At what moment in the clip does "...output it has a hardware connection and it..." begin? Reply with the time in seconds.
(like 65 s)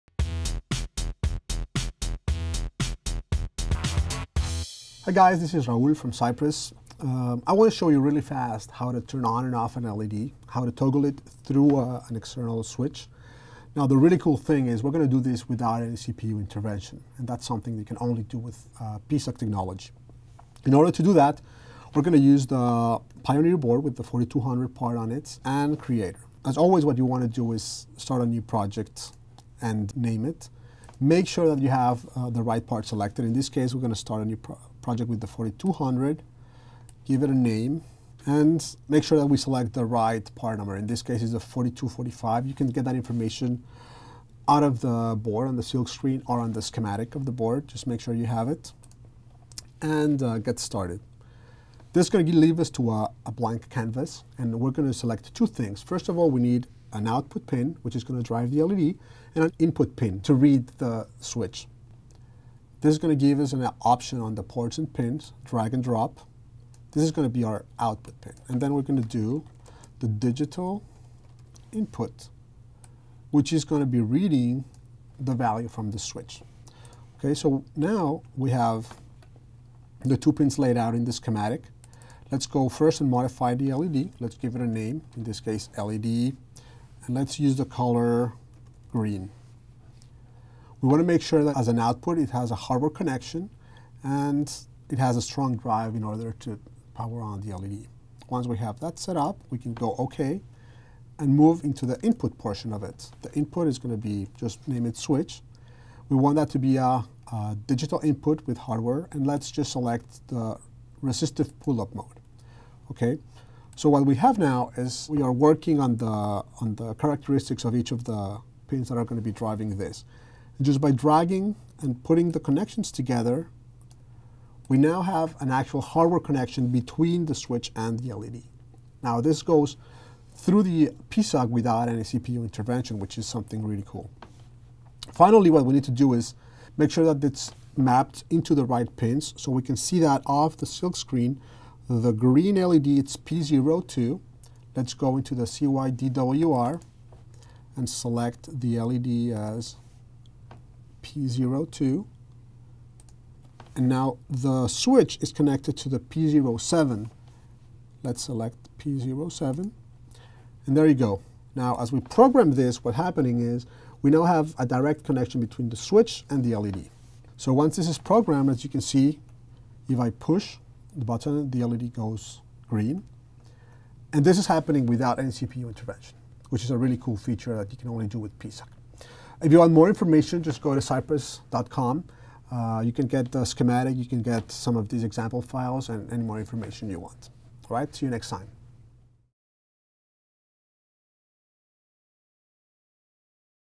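91 s.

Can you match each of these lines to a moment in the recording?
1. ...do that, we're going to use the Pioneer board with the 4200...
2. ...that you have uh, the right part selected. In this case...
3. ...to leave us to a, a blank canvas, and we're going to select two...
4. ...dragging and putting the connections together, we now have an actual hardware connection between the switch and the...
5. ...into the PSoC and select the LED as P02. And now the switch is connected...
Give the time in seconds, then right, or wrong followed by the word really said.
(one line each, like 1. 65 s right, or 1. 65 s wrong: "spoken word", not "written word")
1. 21 s right
2. 31 s right
3. 52 s right
4. 120 s right
5. 145 s wrong: "CYDWR", not "PSoC".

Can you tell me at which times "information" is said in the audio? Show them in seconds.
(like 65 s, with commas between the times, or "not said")
42 s, 179 s, 186 s.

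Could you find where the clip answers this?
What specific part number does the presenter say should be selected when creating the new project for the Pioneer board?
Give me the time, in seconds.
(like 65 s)
41 s.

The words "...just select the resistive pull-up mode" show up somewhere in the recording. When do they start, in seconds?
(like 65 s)
109 s.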